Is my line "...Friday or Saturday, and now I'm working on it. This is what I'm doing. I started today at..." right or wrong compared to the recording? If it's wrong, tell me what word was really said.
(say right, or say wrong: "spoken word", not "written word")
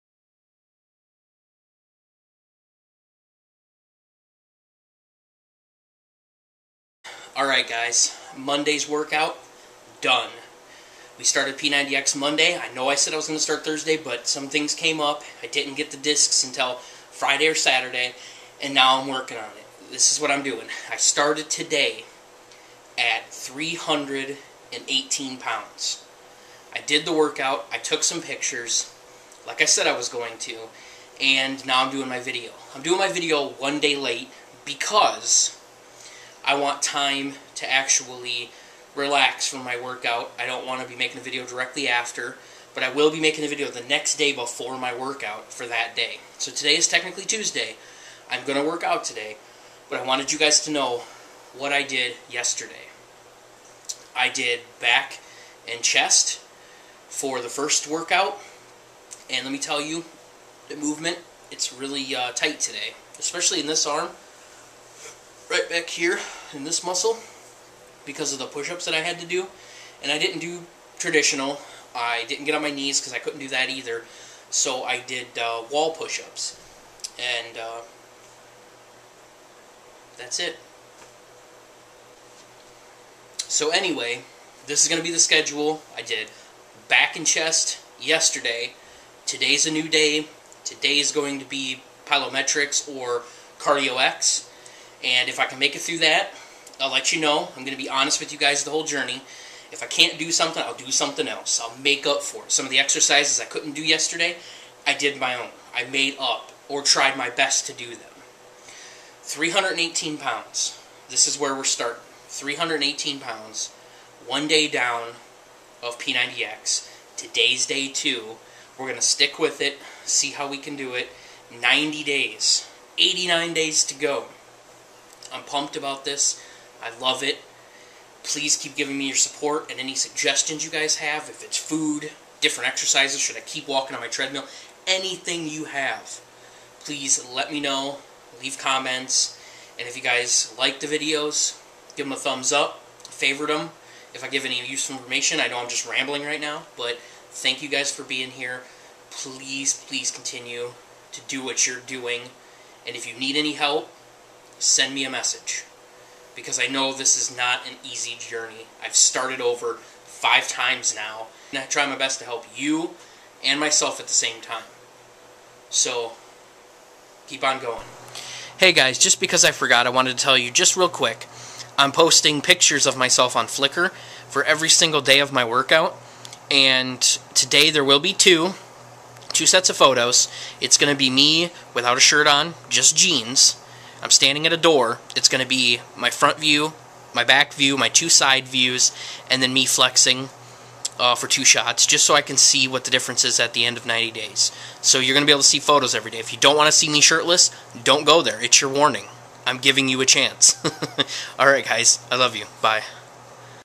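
right.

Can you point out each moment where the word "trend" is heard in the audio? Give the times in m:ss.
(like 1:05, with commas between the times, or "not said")
not said.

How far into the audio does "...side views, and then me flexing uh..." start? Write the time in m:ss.
3:08.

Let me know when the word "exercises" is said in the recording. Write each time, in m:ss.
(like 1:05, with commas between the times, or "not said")
1:42, 2:12.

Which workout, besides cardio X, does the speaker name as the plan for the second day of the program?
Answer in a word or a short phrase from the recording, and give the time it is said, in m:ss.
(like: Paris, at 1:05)
plyometrics, at 1:32.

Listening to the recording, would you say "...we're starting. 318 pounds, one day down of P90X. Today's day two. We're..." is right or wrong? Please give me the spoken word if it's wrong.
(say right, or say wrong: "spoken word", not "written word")
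right.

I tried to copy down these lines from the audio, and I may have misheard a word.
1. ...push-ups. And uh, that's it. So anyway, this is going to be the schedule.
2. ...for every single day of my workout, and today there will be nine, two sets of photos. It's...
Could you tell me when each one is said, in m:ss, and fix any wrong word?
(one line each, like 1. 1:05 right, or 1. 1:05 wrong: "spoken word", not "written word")
1. 1:15 right
2. 2:54 wrong: "two", not "nine".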